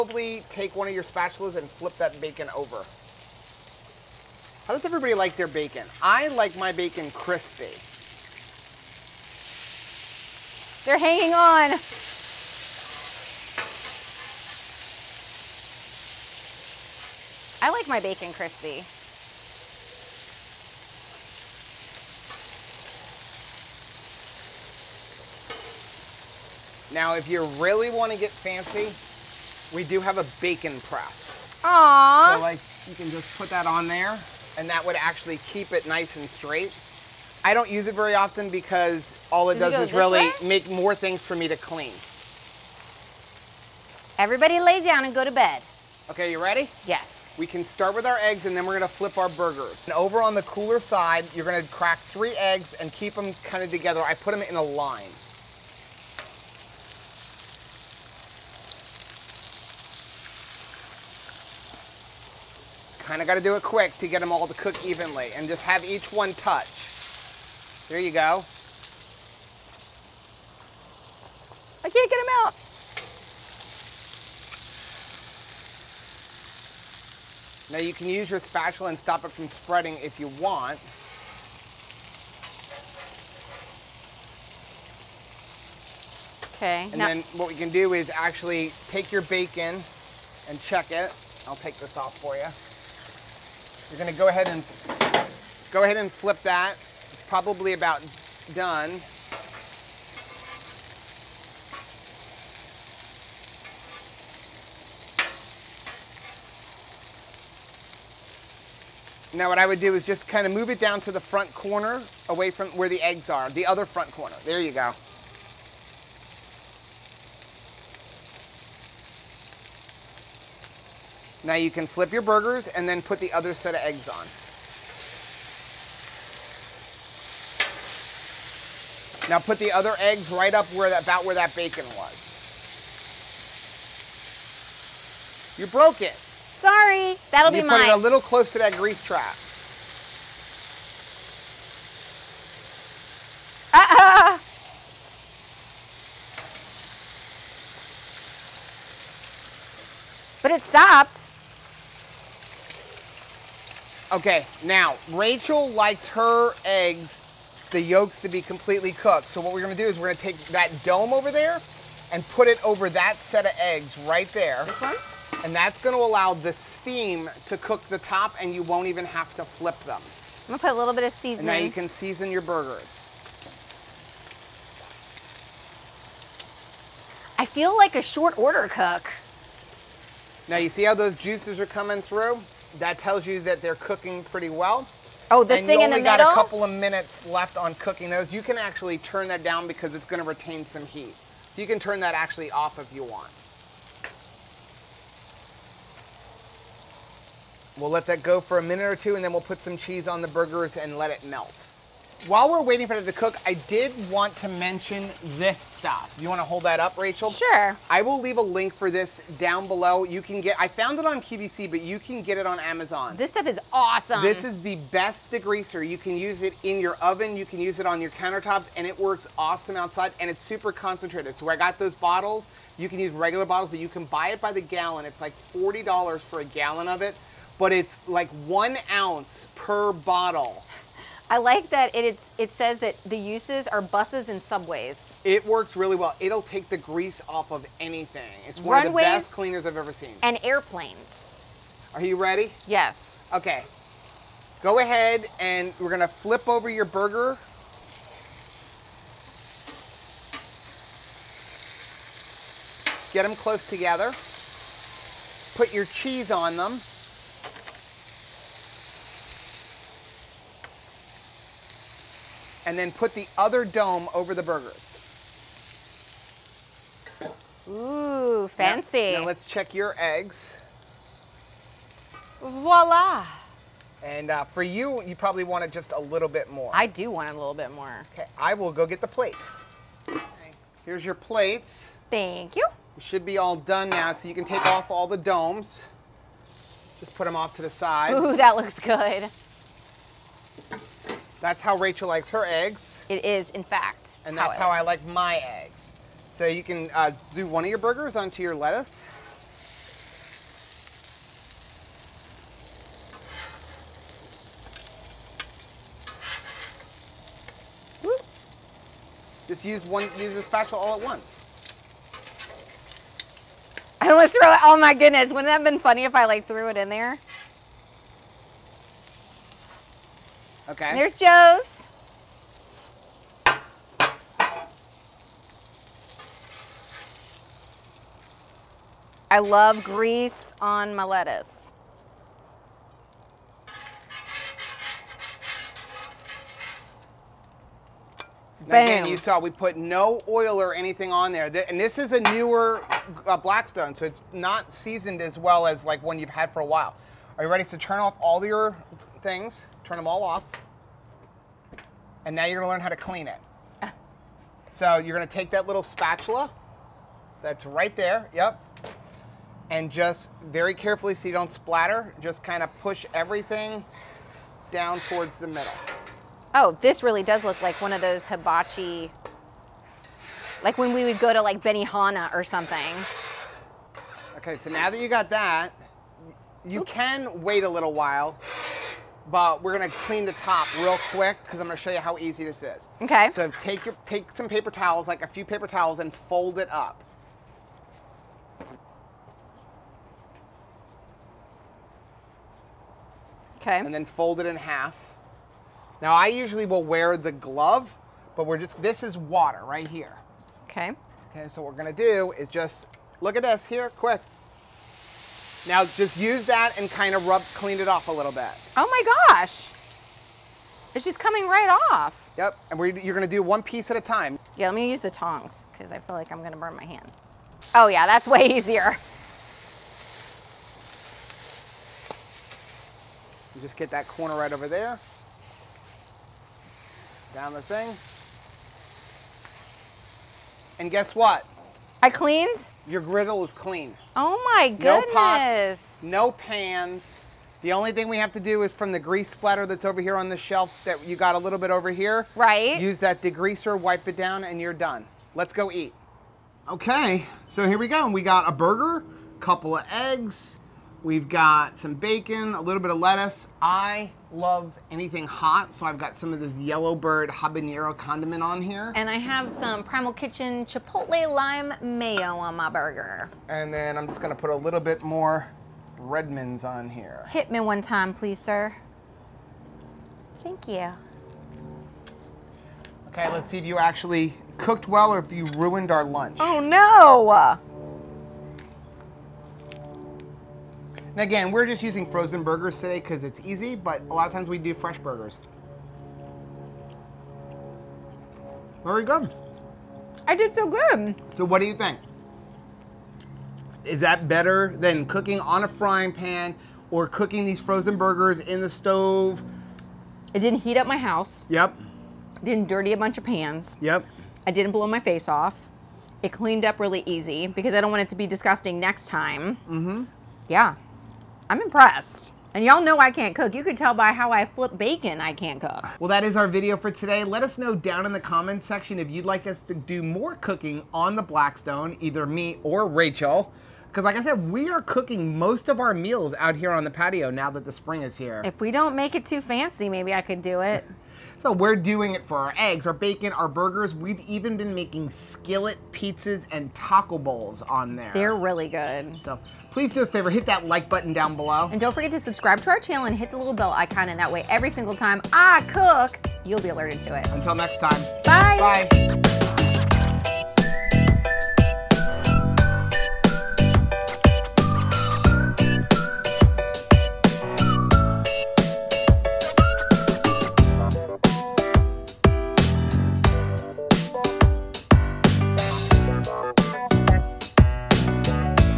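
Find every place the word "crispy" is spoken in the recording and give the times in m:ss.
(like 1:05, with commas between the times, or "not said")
0:07, 0:18.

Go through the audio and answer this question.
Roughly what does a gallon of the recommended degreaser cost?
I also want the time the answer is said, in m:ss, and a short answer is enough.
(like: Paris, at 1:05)
$40, at 3:45.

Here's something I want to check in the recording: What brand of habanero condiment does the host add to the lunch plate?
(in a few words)
Yellowbird.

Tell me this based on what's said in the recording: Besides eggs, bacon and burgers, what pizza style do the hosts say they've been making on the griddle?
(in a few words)
Skillet pizzas.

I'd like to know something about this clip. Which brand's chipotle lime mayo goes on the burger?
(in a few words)
Primal Kitchen.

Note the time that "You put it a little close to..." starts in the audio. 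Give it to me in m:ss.
2:17.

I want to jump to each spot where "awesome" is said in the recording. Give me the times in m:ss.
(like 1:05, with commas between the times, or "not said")
3:33, 3:39.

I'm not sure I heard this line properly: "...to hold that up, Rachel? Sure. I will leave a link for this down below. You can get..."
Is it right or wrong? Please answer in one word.
right.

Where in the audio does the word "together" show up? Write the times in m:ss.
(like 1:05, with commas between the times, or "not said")
0:53, 4:13.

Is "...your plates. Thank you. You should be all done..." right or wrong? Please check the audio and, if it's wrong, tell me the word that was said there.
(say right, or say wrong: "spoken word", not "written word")
right.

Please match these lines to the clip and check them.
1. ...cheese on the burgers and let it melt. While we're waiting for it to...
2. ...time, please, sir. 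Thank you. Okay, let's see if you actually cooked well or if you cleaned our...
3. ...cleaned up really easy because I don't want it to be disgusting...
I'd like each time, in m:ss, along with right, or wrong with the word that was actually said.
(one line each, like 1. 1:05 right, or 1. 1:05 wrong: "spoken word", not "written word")
1. 3:19 right
2. 7:47 wrong: "ruined", not "cleaned"
3. 8:26 right.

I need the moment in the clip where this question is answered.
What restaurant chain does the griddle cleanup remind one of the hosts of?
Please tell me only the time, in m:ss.
6:11.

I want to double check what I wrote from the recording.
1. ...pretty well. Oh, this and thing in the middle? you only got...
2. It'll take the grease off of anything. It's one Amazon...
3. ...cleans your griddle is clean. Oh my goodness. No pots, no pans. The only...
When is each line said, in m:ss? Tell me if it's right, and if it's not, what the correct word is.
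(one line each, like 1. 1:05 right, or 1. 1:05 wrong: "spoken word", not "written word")
1. 3:04 right
2. 3:56 wrong: "Runways", not "Amazon"
3. 7:12 right.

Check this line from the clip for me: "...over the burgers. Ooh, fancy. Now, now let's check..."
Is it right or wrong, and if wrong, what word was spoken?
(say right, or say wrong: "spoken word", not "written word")
right.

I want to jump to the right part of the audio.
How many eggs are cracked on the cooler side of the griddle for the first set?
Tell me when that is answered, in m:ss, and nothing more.
0:51.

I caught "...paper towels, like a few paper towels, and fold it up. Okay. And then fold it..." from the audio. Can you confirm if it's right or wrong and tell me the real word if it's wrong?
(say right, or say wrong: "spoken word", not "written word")
right.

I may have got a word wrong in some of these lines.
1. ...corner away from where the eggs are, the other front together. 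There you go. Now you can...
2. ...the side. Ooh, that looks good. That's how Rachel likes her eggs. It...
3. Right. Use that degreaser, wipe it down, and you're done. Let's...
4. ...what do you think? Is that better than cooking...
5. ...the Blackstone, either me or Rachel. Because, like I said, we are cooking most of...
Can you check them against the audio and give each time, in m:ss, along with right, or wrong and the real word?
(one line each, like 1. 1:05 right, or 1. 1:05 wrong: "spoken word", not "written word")
1. 1:51 wrong: "corner", not "together"
2. 4:47 right
3. 7:22 right
4. 8:11 right
5. 8:41 right.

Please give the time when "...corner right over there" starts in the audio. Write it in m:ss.
7:04.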